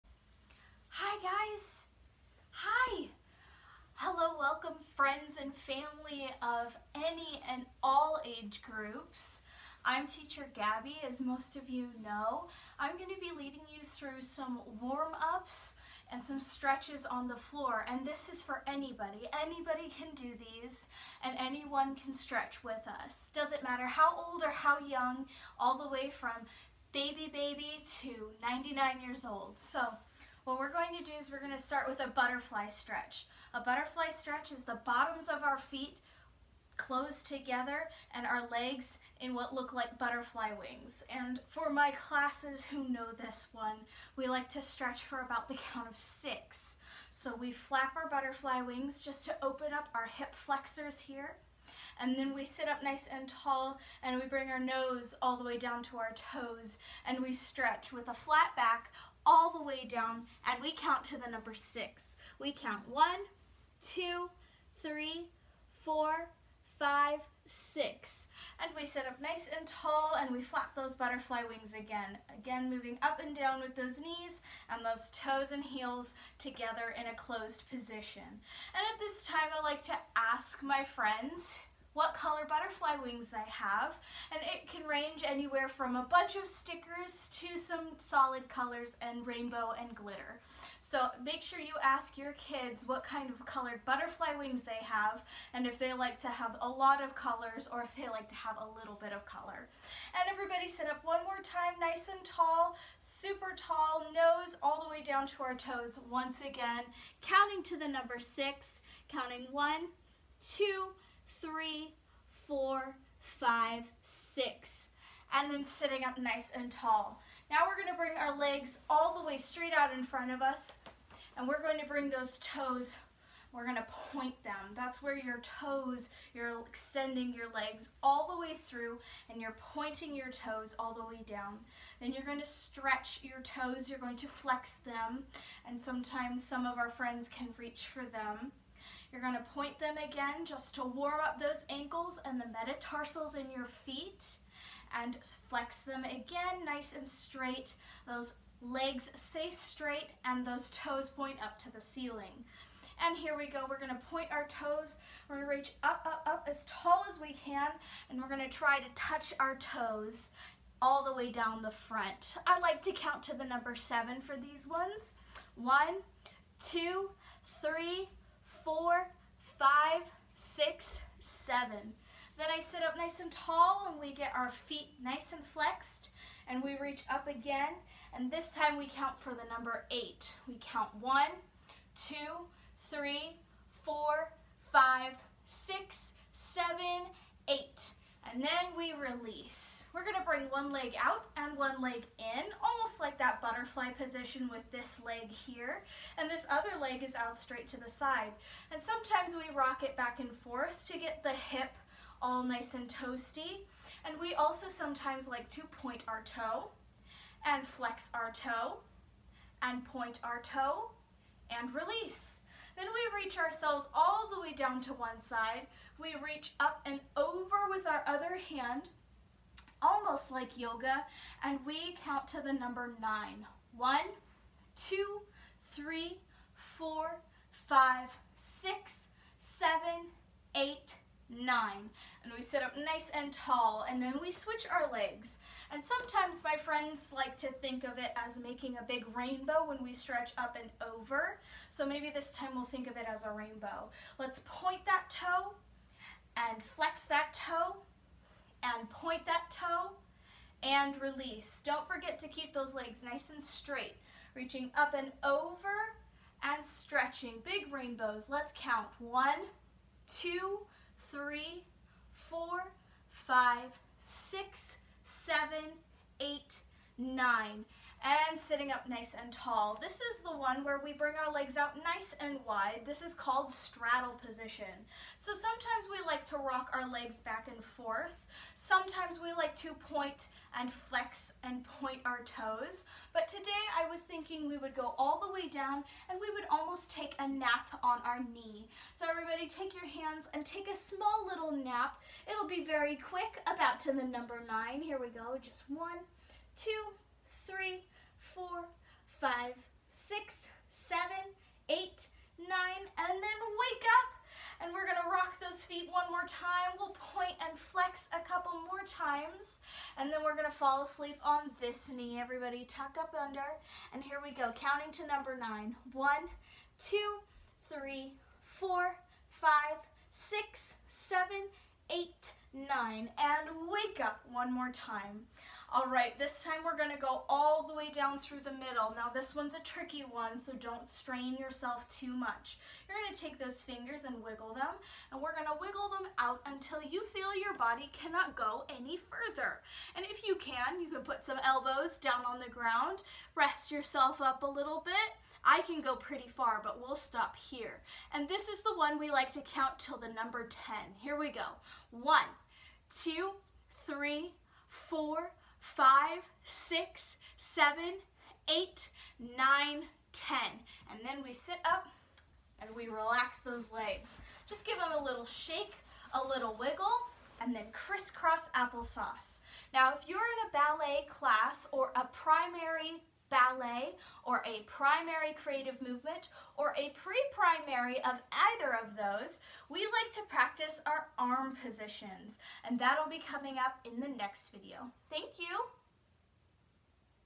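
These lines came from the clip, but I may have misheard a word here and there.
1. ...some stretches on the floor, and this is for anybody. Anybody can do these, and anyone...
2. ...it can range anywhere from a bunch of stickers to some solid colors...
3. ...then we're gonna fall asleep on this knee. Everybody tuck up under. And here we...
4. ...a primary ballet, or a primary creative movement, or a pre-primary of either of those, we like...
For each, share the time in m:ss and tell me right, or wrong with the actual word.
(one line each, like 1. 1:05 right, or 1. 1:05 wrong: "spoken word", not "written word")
1. 0:16 right
2. 1:24 right
3. 5:10 right
4. 6:11 right.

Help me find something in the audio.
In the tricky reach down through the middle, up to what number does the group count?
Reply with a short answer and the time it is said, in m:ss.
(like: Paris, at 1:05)
10, at 5:50.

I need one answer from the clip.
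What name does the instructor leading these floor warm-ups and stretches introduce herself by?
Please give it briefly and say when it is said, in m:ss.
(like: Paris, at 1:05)
Teacher Gabby, at 0:10.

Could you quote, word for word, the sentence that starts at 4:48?
So everybody take your hands and take a small little nap.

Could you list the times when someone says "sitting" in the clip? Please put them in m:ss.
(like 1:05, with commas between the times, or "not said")
1:55, 4:28.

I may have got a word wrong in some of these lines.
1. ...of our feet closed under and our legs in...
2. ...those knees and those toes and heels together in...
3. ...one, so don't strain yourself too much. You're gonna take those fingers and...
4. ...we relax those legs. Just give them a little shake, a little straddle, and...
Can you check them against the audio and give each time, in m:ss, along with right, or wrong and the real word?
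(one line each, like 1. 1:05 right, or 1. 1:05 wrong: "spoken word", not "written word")
1. 0:35 wrong: "together", not "under"
2. 1:13 right
3. 5:30 right
4. 6:02 wrong: "wiggle", not "straddle".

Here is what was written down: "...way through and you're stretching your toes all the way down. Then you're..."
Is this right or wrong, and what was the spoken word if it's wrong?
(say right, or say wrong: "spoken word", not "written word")
wrong: "pointing", not "stretching".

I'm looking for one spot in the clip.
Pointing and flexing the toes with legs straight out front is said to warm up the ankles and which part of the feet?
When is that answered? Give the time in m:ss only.
2:22.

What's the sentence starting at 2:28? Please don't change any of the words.
Those legs stay straight and those toes point up to the ceiling.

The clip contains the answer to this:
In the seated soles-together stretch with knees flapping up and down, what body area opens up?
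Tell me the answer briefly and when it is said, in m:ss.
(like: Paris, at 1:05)
hip flexors, at 0:50.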